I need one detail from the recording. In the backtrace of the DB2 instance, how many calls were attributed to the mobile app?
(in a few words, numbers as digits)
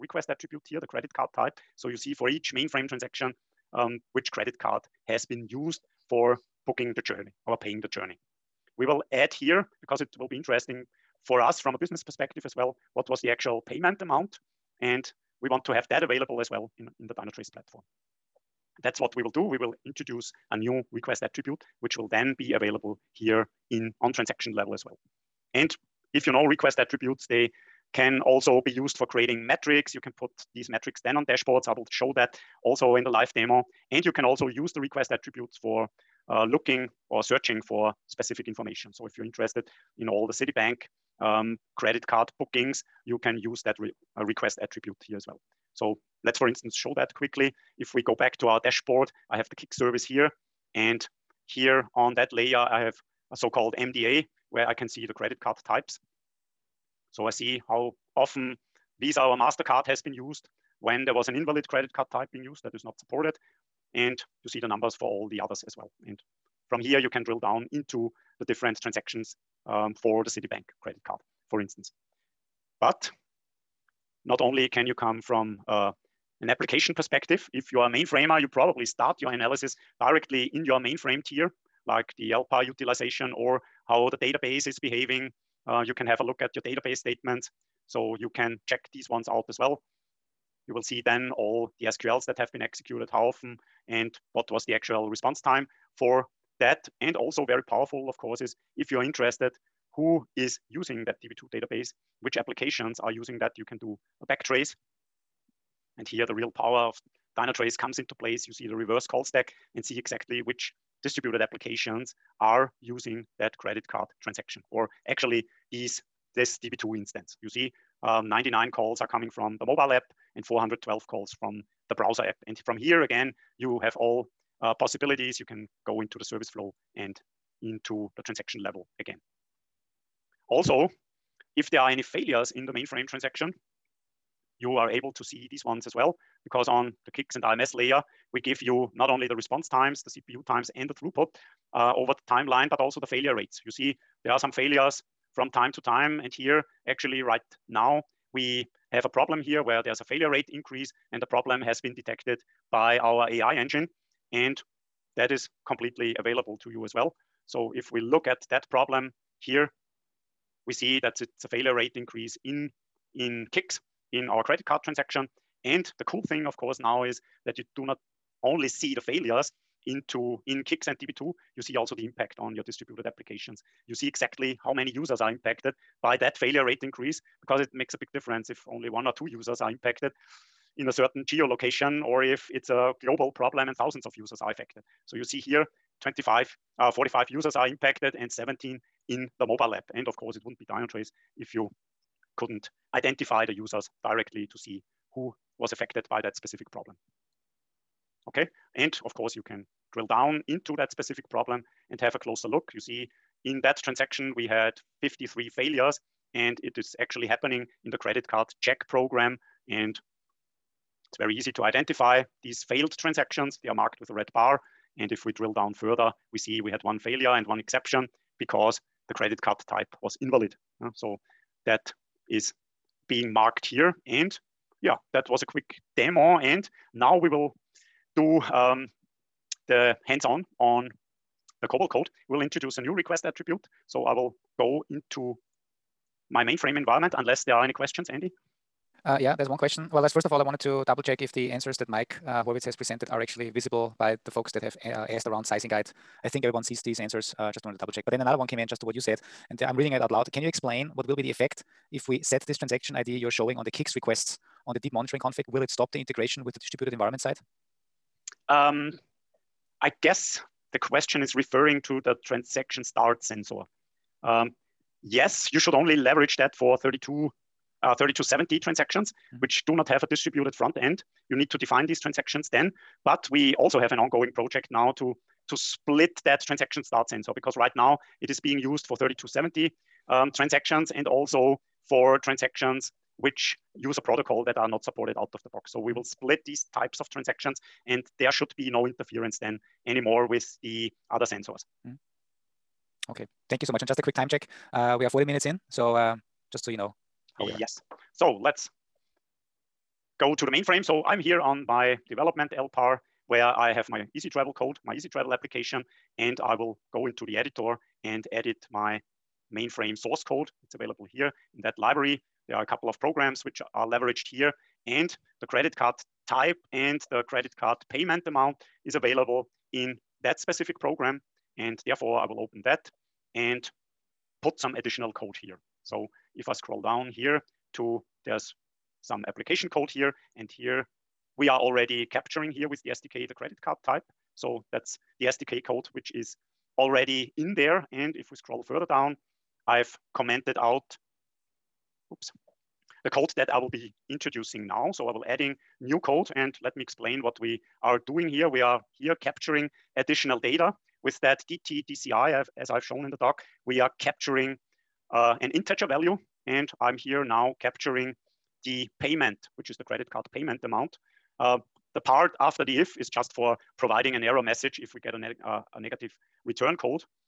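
99.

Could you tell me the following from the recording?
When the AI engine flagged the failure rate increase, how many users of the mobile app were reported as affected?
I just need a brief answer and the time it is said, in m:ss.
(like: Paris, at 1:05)
17, at 3:08.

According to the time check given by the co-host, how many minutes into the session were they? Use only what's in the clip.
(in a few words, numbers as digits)
40.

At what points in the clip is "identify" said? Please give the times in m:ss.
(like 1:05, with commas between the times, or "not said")
3:12, 3:31.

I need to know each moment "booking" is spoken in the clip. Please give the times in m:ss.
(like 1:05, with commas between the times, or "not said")
0:06, 0:42.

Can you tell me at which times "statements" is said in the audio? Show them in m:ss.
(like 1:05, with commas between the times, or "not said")
1:26.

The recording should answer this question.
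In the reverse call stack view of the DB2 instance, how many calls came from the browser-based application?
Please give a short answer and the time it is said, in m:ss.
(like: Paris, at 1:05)
412, at 2:00.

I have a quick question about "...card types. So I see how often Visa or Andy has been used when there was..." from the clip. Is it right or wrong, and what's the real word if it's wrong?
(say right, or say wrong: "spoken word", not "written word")
wrong: "MasterCard", not "Andy".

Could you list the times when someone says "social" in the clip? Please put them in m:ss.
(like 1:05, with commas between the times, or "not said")
not said.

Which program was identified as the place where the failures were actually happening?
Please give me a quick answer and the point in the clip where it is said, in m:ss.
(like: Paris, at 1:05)
credit card check program, at 3:27.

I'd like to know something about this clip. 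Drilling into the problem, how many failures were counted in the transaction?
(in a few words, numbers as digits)
53.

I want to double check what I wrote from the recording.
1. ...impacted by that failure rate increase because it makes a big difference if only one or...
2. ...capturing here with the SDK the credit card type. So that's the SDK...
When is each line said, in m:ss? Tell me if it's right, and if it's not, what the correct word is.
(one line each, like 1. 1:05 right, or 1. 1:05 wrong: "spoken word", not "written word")
1. 2:55 right
2. 5:32 right.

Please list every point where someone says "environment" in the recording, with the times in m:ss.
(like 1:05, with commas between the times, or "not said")
3:56, 4:16.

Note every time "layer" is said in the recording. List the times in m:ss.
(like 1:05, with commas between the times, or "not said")
0:52, 2:17.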